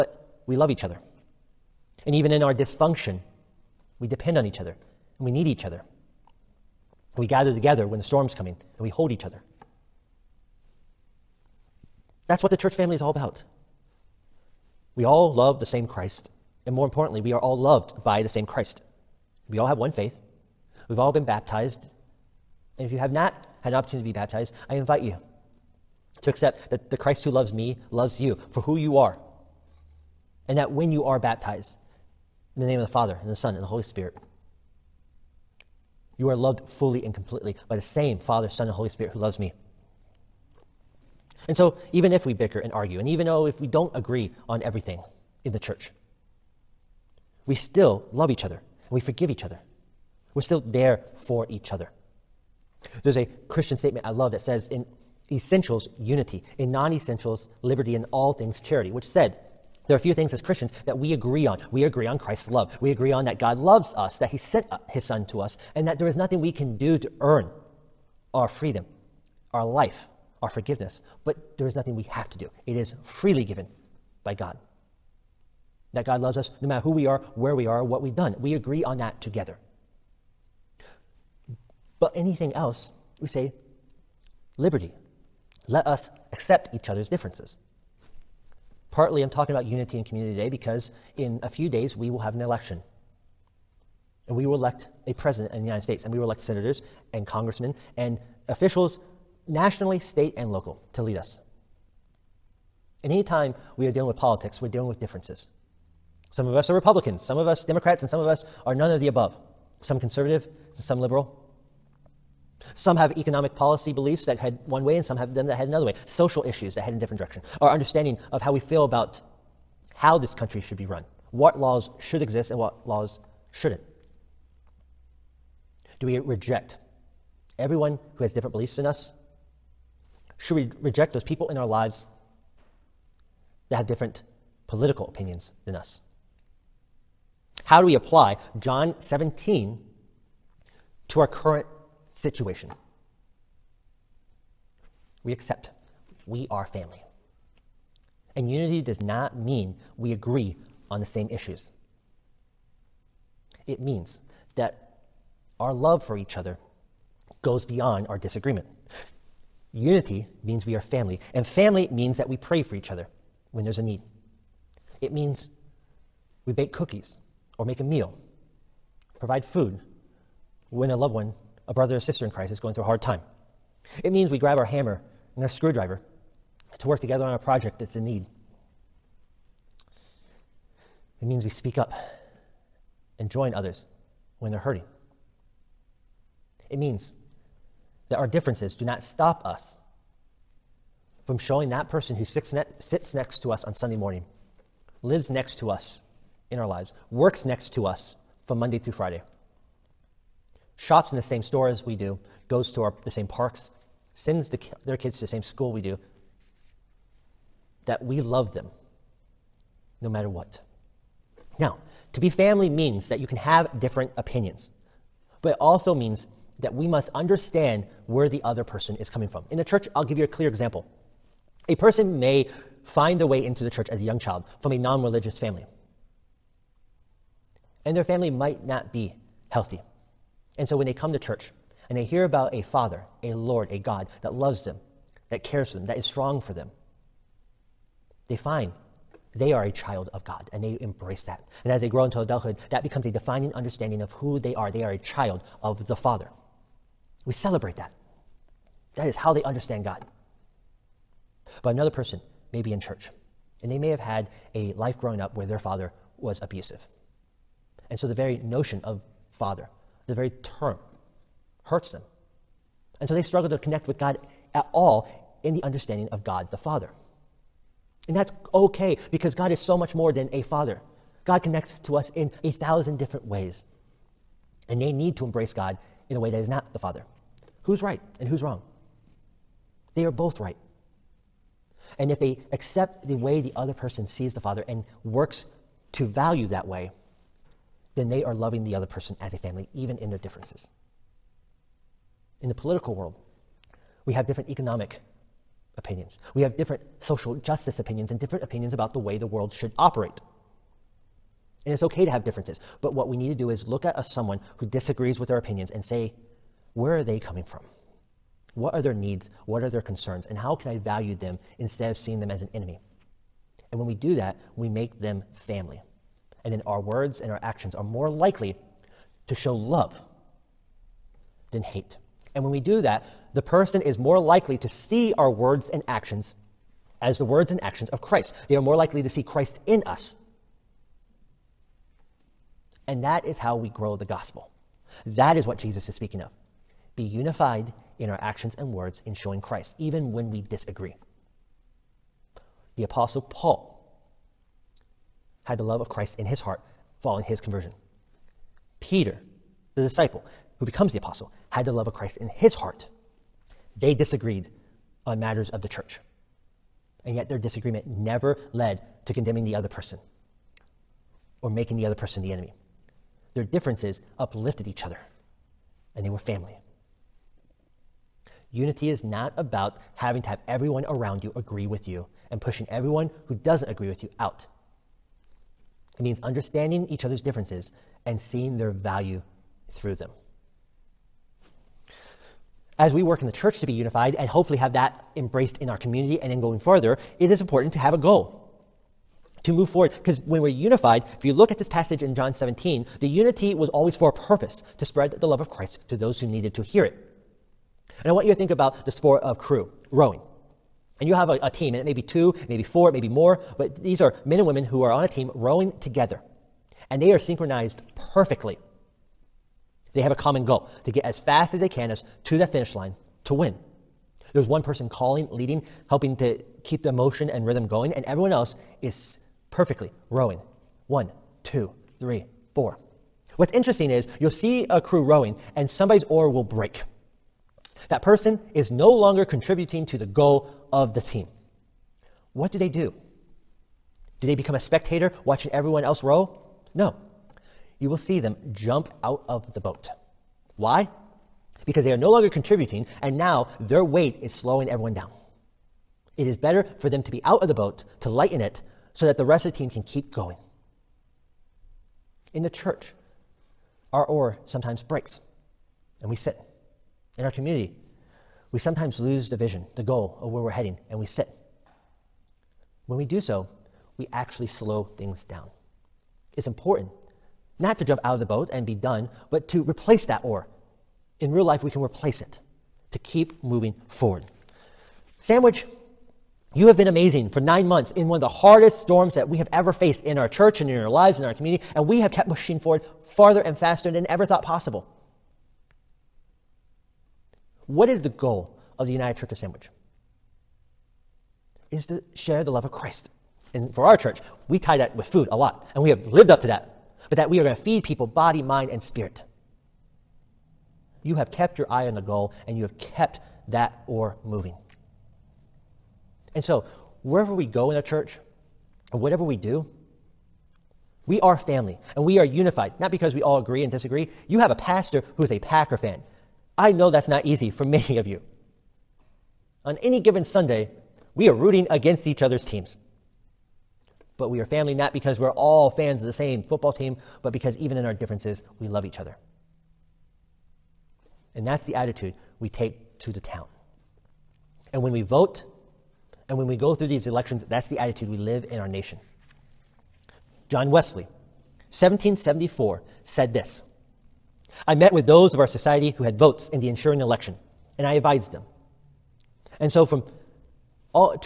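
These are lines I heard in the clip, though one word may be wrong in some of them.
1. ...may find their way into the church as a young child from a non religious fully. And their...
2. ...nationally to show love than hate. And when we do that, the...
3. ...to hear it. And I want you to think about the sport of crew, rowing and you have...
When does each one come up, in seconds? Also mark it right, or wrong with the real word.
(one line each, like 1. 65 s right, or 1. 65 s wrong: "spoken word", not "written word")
1. 222 s wrong: "family", not "fully"
2. 318 s wrong: "likely", not "nationally"
3. 396 s right.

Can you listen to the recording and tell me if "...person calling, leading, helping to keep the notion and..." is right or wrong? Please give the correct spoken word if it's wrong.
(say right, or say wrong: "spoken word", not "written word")
wrong: "motion", not "notion".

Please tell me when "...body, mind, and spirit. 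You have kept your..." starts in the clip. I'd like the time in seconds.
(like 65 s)
498 s.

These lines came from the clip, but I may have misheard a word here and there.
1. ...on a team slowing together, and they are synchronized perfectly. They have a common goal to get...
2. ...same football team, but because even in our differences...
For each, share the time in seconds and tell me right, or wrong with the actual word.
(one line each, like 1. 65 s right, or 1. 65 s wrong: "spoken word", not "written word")
1. 404 s wrong: "rowing", not "slowing"
2. 526 s right.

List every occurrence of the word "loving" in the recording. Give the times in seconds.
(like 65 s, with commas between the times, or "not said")
288 s.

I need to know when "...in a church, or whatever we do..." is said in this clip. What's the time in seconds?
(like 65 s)
507 s.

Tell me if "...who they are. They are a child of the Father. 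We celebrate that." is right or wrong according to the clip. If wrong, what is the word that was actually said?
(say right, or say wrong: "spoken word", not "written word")
right.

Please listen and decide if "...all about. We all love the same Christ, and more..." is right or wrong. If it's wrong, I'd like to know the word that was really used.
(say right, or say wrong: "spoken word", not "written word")
right.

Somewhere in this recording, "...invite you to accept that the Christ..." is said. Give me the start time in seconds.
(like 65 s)
24 s.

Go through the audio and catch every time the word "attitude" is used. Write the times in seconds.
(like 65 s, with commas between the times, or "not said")
531 s, 537 s.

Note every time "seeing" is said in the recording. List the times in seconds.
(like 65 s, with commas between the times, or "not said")
311 s, 378 s.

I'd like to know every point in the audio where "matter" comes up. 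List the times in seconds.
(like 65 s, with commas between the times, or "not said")
76 s, 210 s, 355 s.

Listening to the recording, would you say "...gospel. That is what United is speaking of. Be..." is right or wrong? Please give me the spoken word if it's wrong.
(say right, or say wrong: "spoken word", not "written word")
wrong: "Jesus", not "United".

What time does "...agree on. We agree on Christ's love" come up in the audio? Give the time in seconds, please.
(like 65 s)
61 s.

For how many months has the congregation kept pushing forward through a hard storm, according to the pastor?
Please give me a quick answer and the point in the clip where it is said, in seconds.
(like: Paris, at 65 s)
9, at 477 s.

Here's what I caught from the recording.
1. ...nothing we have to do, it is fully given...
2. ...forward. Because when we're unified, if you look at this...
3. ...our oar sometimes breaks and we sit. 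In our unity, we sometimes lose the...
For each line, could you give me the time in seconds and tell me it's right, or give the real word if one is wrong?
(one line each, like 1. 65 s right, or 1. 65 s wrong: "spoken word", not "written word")
1. 71 s wrong: "freely", not "fully"
2. 389 s right
3. 453 s wrong: "community", not "unity".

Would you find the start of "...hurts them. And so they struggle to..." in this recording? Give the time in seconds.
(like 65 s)
261 s.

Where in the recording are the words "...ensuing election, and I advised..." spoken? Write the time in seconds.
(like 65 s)
546 s.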